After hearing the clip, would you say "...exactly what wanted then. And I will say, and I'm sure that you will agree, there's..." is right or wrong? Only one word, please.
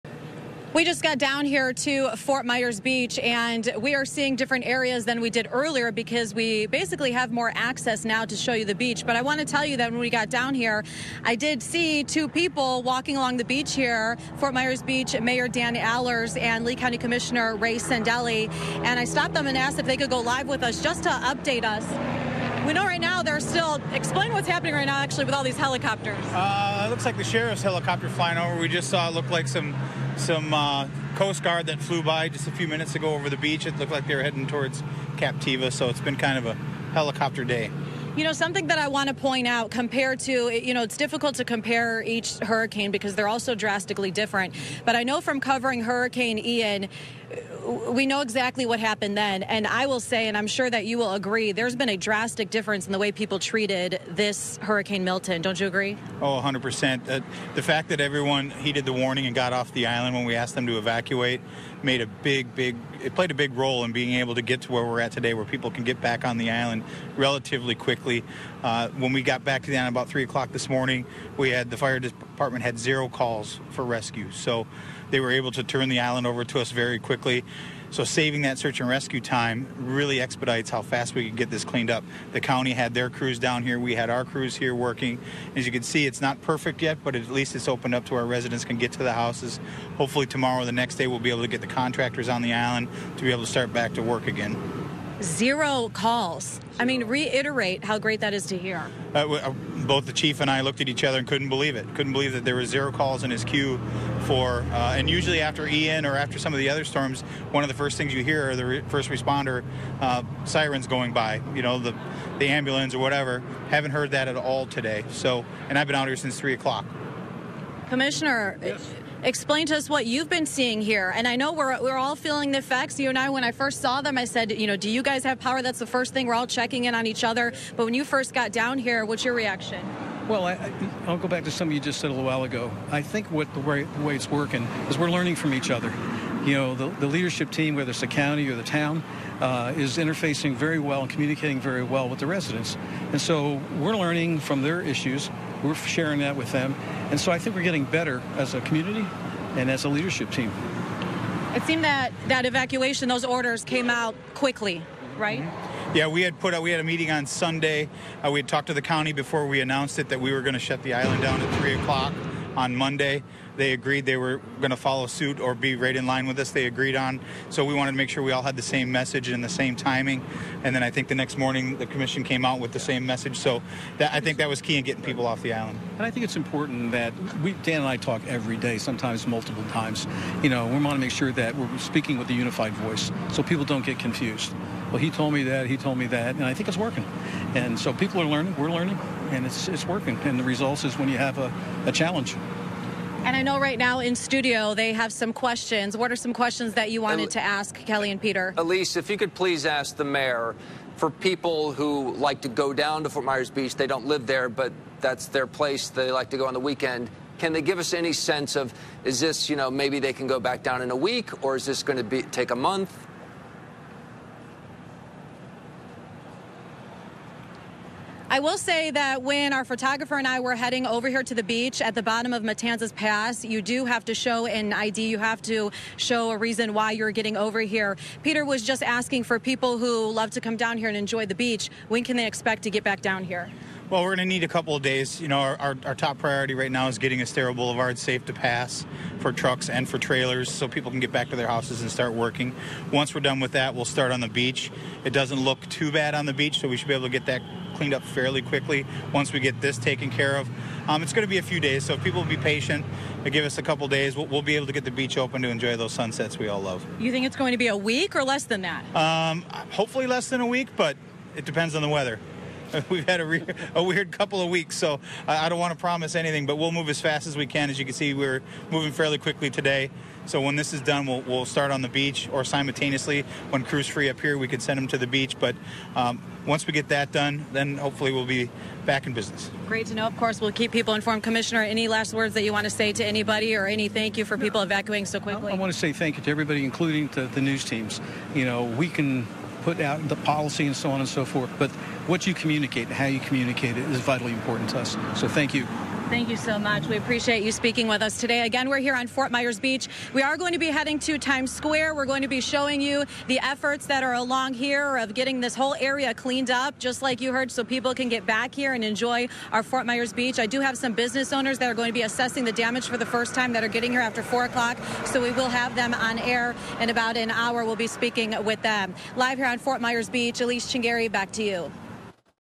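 wrong.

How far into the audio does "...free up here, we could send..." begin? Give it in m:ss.
4:33.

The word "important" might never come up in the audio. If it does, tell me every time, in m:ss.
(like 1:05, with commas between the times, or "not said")
2:56, 4:54.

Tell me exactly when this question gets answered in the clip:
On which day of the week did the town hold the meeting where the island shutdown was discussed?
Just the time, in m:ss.
2:37.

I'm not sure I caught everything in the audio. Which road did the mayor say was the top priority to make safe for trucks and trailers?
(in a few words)
Estero Boulevard.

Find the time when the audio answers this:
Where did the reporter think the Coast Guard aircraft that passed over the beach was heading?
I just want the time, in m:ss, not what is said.
0:35.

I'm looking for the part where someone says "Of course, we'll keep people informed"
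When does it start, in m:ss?
4:40.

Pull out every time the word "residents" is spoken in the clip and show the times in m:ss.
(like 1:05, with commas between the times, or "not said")
1:28, 2:22.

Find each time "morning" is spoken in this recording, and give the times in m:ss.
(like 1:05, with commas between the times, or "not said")
1:10, 2:51.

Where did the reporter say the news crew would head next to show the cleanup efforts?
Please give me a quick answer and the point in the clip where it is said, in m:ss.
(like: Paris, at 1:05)
Times Square, at 5:01.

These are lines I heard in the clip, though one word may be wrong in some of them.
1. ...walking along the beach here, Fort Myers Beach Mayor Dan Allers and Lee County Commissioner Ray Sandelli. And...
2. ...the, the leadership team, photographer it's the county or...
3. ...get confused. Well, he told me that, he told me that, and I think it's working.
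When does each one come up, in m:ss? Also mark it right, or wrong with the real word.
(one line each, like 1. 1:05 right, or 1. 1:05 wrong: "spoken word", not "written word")
1. 0:12 right
2. 2:16 wrong: "whether", not "photographer"
3. 3:03 right.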